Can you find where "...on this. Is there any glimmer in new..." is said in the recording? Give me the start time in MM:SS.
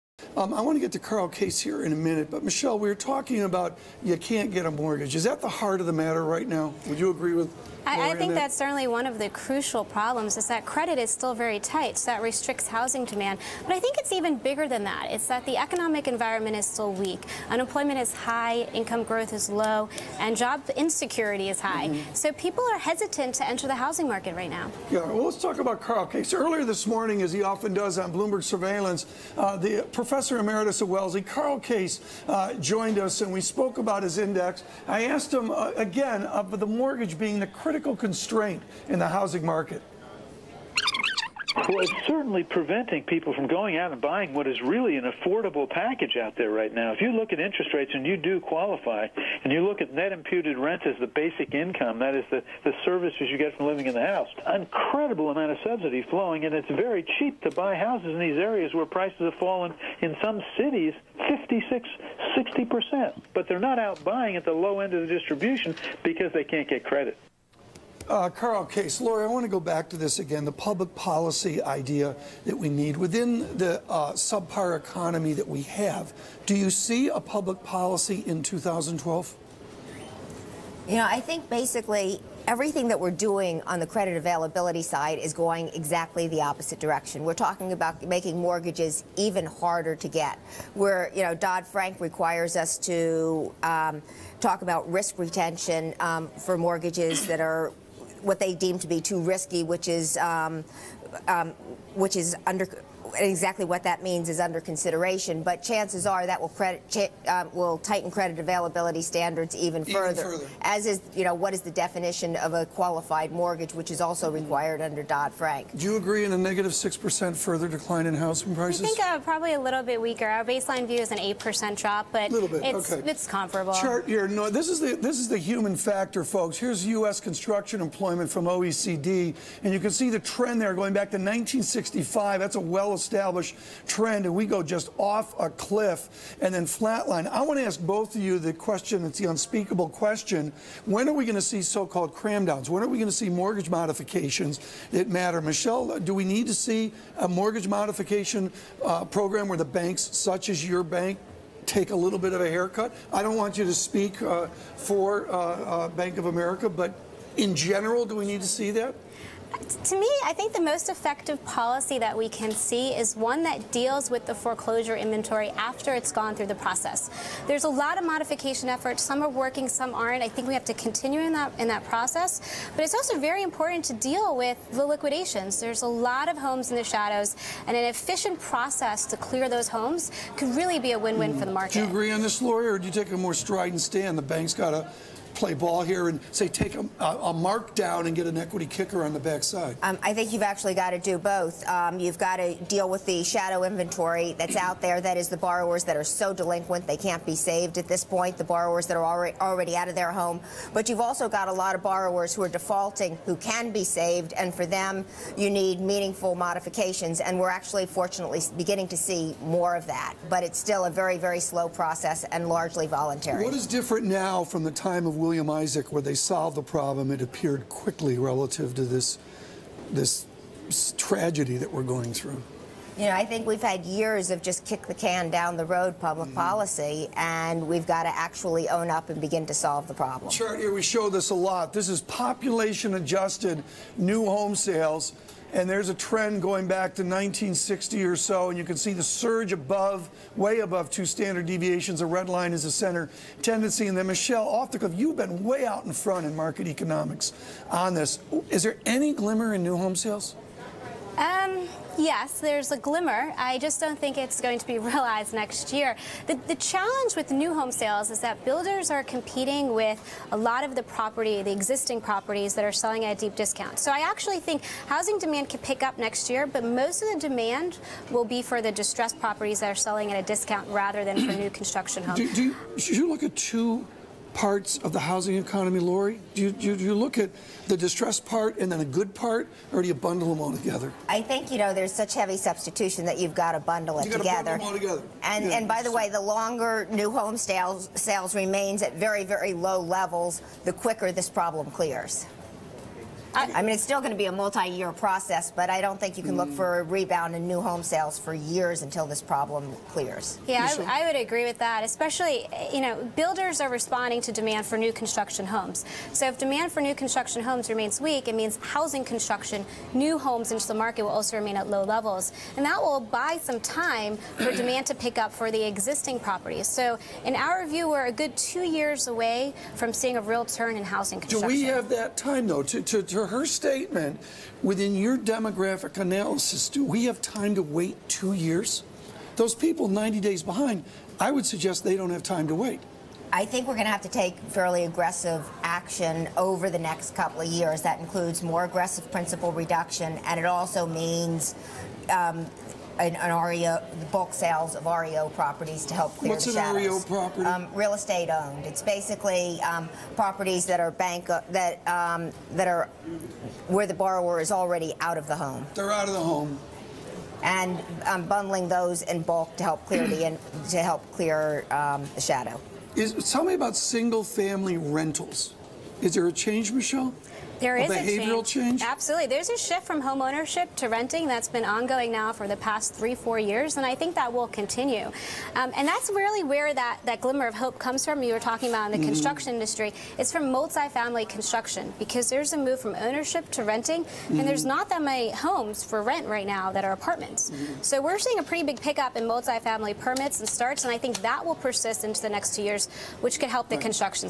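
04:07.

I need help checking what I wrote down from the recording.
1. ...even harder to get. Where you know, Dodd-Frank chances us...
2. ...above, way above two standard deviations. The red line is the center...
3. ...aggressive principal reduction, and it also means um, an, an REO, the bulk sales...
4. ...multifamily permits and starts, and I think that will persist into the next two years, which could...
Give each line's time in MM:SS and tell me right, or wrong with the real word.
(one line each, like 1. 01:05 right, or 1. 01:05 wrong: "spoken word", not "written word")
1. 01:29 wrong: "requires", not "chances"
2. 03:59 right
3. 05:38 right
4. 06:29 right.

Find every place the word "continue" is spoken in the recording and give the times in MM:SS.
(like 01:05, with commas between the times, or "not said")
02:50, 06:14.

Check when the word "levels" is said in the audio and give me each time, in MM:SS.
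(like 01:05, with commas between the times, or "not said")
04:49, 05:11.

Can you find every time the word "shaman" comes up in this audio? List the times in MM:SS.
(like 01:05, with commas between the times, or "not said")
not said.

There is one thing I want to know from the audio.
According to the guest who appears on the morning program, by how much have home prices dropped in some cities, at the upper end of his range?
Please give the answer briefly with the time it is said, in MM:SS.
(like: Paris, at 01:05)
60%, at 01:02.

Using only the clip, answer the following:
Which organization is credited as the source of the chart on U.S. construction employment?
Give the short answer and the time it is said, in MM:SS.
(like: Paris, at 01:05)
OECD, at 02:08.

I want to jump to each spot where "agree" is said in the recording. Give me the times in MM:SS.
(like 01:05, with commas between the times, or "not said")
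00:07, 01:55, 03:01, 05:01.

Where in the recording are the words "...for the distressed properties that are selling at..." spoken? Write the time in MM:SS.
04:28.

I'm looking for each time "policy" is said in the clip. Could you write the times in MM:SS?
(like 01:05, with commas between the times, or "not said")
01:10, 01:17, 02:41, 03:46.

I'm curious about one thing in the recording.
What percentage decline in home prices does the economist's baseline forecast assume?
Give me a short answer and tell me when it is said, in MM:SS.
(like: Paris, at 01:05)
8%, at 02:01.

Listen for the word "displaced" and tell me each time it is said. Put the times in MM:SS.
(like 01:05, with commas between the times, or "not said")
not said.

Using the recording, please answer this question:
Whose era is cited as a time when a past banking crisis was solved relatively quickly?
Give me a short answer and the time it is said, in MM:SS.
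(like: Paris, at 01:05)
William Isaac, at 03:35.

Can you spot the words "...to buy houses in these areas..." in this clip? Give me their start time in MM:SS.
00:57.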